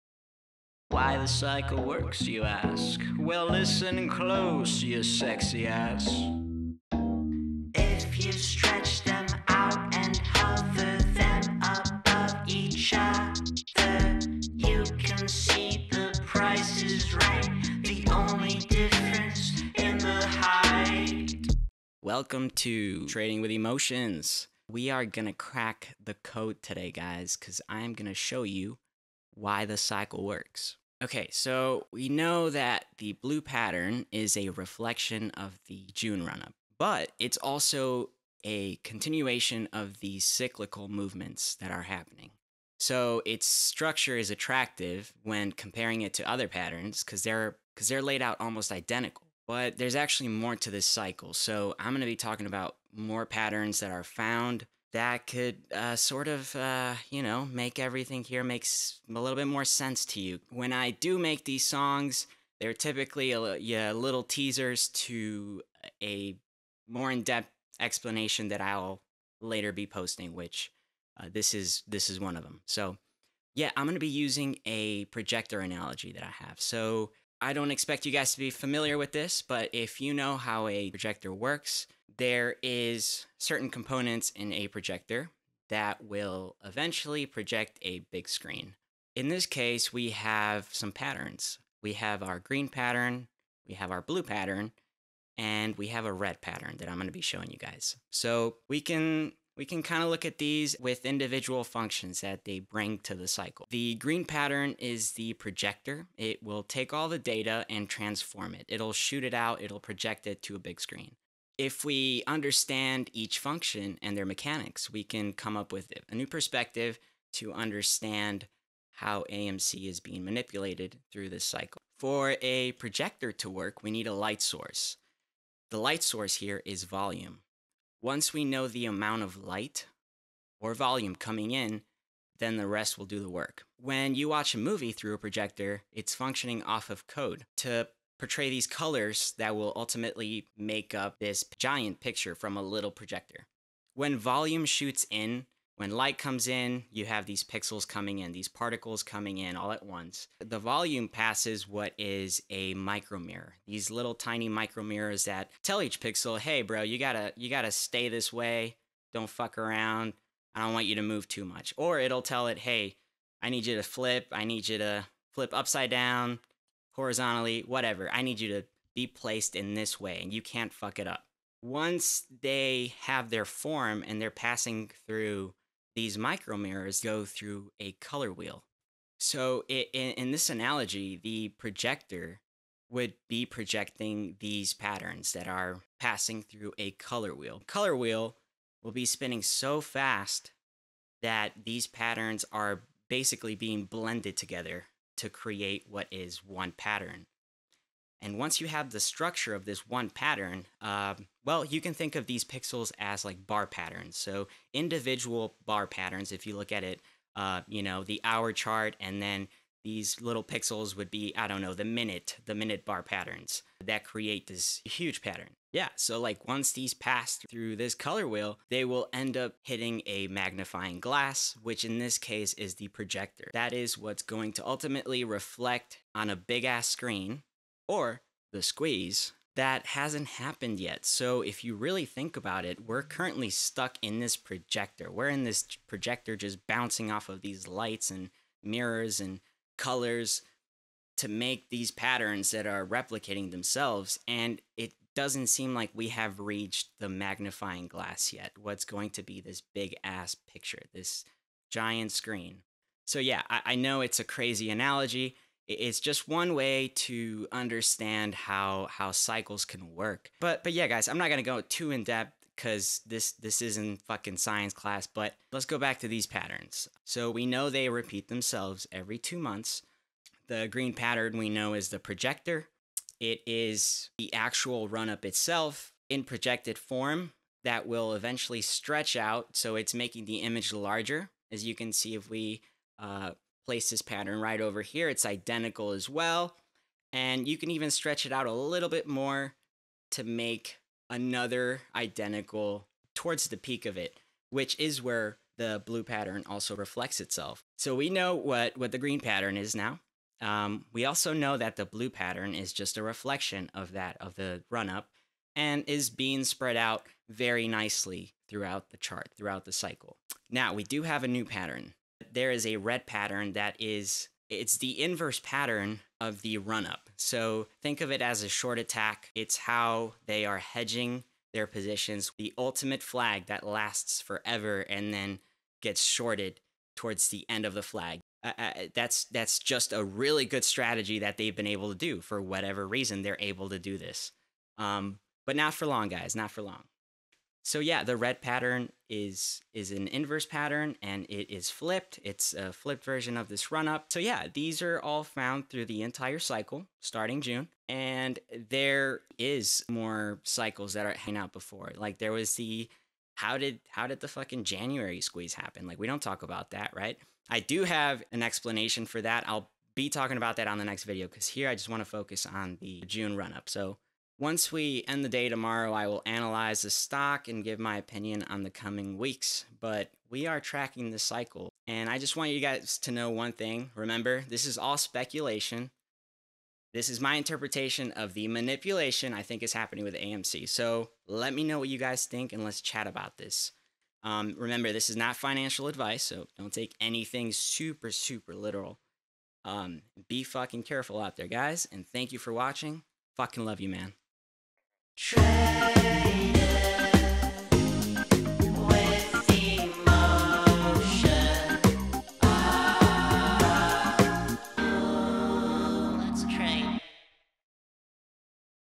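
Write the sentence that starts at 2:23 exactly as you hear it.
When volume shoots in, when light comes in, you have these pixels coming in, these particles coming in all at once.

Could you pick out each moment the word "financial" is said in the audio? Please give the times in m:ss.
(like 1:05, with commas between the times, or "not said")
6:25.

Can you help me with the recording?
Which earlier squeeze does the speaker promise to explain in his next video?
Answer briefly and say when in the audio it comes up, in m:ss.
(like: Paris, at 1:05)
January squeeze, at 5:54.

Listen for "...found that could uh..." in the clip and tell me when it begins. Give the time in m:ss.
0:54.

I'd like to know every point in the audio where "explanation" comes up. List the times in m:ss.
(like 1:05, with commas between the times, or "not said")
1:07, 5:58.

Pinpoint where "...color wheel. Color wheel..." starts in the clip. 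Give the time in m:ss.
3:06.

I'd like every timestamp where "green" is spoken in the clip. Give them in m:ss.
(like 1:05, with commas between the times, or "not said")
1:32, 1:43, 4:30, 4:58.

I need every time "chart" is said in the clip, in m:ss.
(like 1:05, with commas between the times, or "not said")
3:28, 5:08.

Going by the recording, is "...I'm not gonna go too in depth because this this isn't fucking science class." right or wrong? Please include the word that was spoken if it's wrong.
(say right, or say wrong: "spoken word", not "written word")
right.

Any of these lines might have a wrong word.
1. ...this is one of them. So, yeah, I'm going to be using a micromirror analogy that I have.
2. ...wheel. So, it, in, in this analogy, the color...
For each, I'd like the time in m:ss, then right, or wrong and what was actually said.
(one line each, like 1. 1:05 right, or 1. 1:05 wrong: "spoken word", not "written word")
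1. 1:11 wrong: "projector", not "micromirror"
2. 2:58 wrong: "projector", not "color".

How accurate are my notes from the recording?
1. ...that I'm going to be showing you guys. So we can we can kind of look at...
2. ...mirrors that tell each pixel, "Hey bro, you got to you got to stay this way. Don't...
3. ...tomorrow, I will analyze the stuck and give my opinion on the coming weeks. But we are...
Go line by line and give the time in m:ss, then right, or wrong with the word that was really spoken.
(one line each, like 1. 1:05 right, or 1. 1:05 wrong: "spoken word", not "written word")
1. 1:36 right
2. 2:34 wrong: "micromirrors", not "mirrors"
3. 6:05 wrong: "stock", not "stuck".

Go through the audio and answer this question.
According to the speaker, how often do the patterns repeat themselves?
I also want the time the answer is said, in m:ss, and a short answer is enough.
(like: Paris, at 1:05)
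Every two months, at 4:28.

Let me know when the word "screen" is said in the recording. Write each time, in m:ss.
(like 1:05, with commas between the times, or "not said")
1:28, 1:50, 3:46, 4:12.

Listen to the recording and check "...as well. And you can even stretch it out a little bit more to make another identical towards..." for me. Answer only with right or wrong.
right.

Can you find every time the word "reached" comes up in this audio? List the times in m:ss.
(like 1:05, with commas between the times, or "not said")
4:06.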